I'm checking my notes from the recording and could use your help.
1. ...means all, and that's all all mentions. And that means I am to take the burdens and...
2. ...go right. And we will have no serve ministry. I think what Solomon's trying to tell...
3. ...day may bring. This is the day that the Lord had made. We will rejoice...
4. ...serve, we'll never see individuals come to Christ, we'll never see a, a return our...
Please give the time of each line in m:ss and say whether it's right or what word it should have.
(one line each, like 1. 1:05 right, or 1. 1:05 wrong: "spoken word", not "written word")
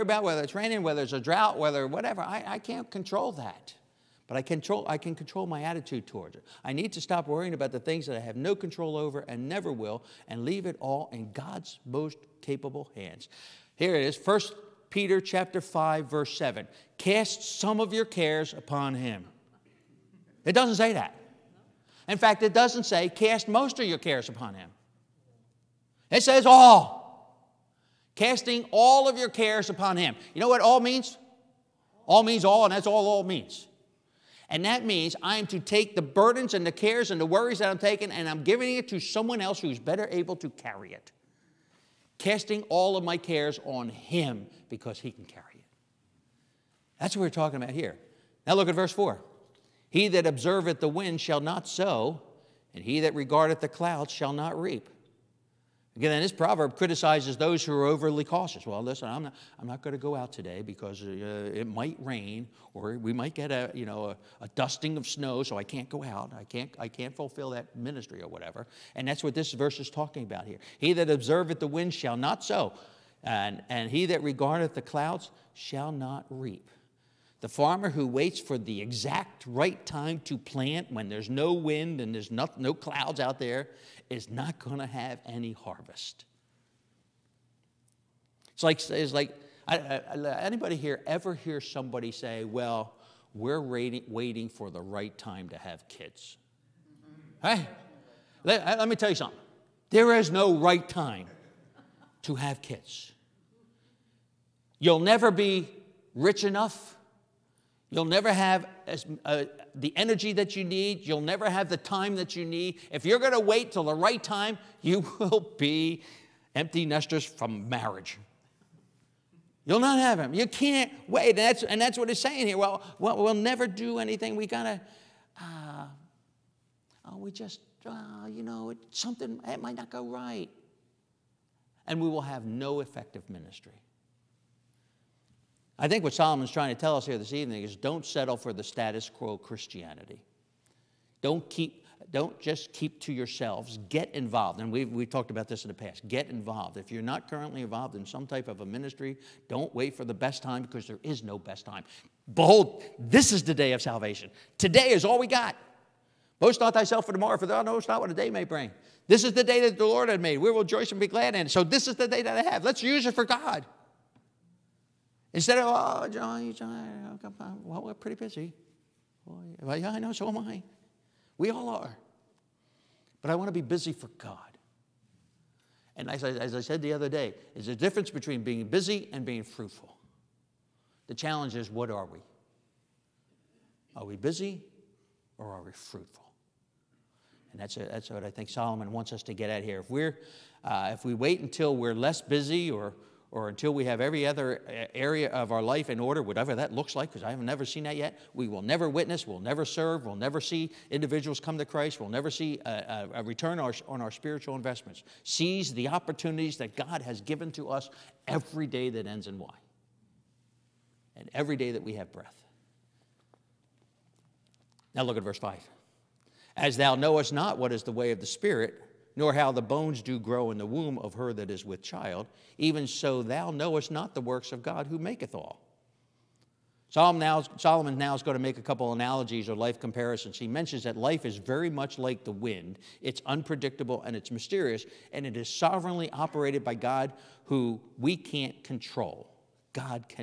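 1. 0:32 wrong: "means", not "mentions"
2. 2:09 wrong: "effective", not "serve"
3. 2:38 right
4. 3:19 right.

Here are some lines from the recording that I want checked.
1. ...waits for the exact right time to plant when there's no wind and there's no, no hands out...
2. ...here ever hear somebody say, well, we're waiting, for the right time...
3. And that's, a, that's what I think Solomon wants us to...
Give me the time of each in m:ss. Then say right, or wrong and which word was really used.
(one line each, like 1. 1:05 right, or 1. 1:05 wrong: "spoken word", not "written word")
1. 1:18 wrong: "clouds", not "hands"
2. 1:30 right
3. 3:07 right.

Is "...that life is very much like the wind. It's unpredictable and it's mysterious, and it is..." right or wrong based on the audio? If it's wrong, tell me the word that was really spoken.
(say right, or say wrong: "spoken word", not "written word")
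right.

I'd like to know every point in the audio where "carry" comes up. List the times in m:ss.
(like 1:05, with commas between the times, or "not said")
0:40, 0:45.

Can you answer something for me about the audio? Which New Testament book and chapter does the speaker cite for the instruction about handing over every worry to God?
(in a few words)
1 Peter chapter 5.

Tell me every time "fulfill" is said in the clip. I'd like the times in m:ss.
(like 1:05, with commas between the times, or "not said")
1:07.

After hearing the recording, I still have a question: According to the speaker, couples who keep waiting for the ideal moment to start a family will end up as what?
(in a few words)
Empty nesters.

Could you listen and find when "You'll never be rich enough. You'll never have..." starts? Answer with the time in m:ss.
1:44.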